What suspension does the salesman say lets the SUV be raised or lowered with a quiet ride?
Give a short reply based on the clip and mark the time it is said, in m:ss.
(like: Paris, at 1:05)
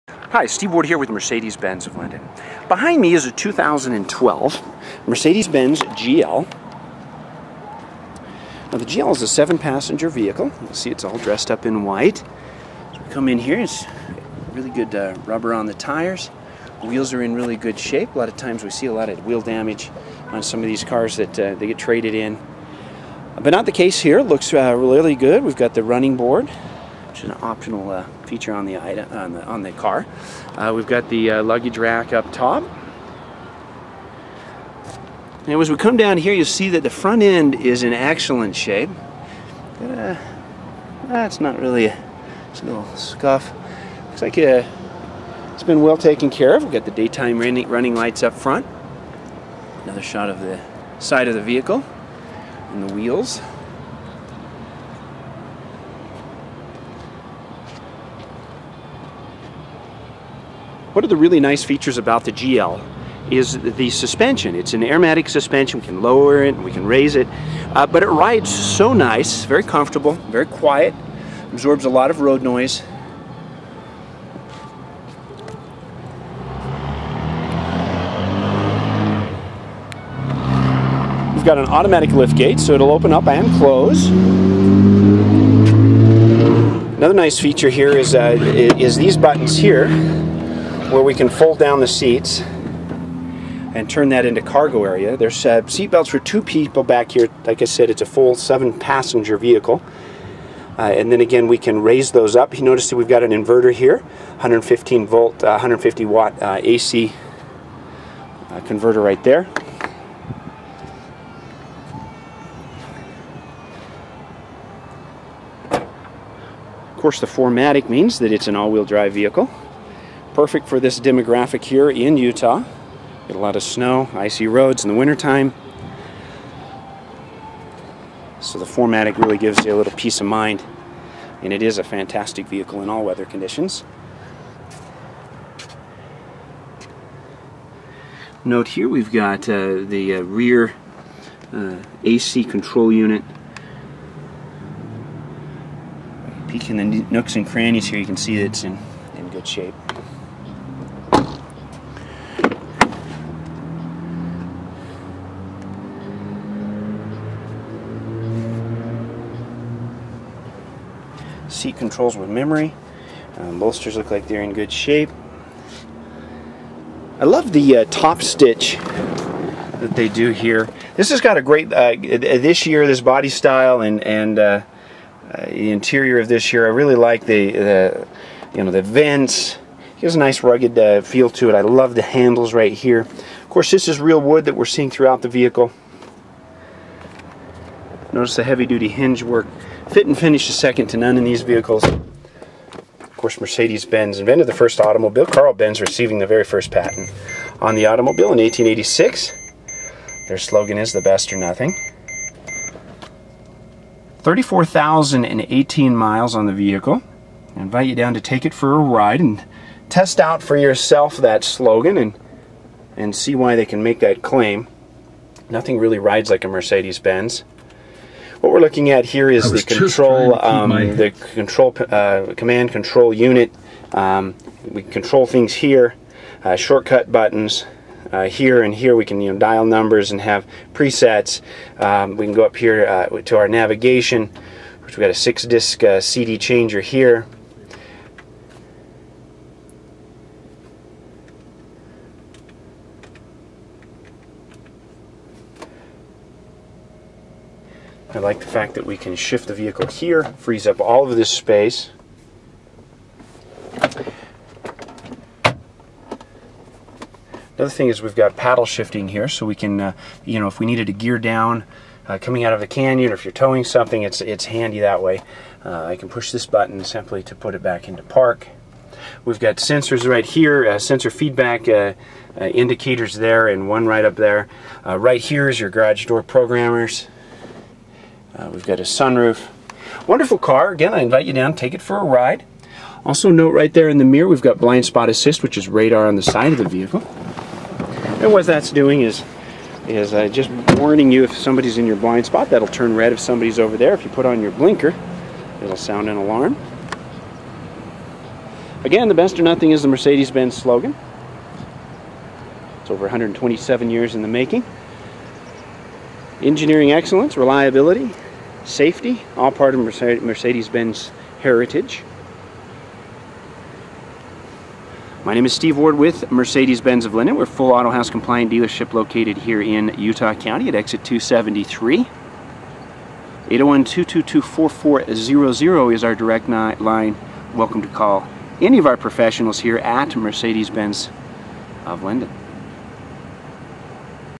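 Airmatic suspension, at 1:04.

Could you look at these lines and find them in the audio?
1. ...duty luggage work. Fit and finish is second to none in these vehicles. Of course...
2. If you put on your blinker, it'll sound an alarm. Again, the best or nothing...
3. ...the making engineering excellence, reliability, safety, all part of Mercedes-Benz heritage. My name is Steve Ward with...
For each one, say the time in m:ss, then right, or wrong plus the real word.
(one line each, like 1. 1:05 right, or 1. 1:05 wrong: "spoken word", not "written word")
1. 3:08 wrong: "hinge", not "luggage"
2. 4:53 right
3. 5:04 right.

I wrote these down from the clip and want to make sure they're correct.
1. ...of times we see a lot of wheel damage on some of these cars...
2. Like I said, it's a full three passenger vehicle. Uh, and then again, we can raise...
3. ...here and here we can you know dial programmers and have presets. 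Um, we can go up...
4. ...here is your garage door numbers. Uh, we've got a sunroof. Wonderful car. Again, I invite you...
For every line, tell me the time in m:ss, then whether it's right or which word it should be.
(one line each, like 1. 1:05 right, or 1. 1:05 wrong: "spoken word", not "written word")
1. 0:18 right
2. 1:37 wrong: "seven", not "three"
3. 3:48 wrong: "numbers", not "programmers"
4. 4:35 wrong: "programmers", not "numbers".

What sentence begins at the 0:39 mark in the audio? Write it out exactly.
Uh, that's not really a, it's a little scuff.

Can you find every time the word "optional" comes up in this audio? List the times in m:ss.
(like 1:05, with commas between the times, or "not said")
0:27.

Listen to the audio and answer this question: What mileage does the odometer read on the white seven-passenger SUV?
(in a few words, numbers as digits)
34,018.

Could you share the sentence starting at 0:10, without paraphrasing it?
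You'll see it's all dressed up in white.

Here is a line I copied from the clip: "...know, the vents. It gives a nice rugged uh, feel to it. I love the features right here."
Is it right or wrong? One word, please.
wrong.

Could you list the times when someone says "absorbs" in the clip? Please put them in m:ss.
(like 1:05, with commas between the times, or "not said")
1:11.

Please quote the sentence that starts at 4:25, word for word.
Uh, I can push this button simply to put it back into park.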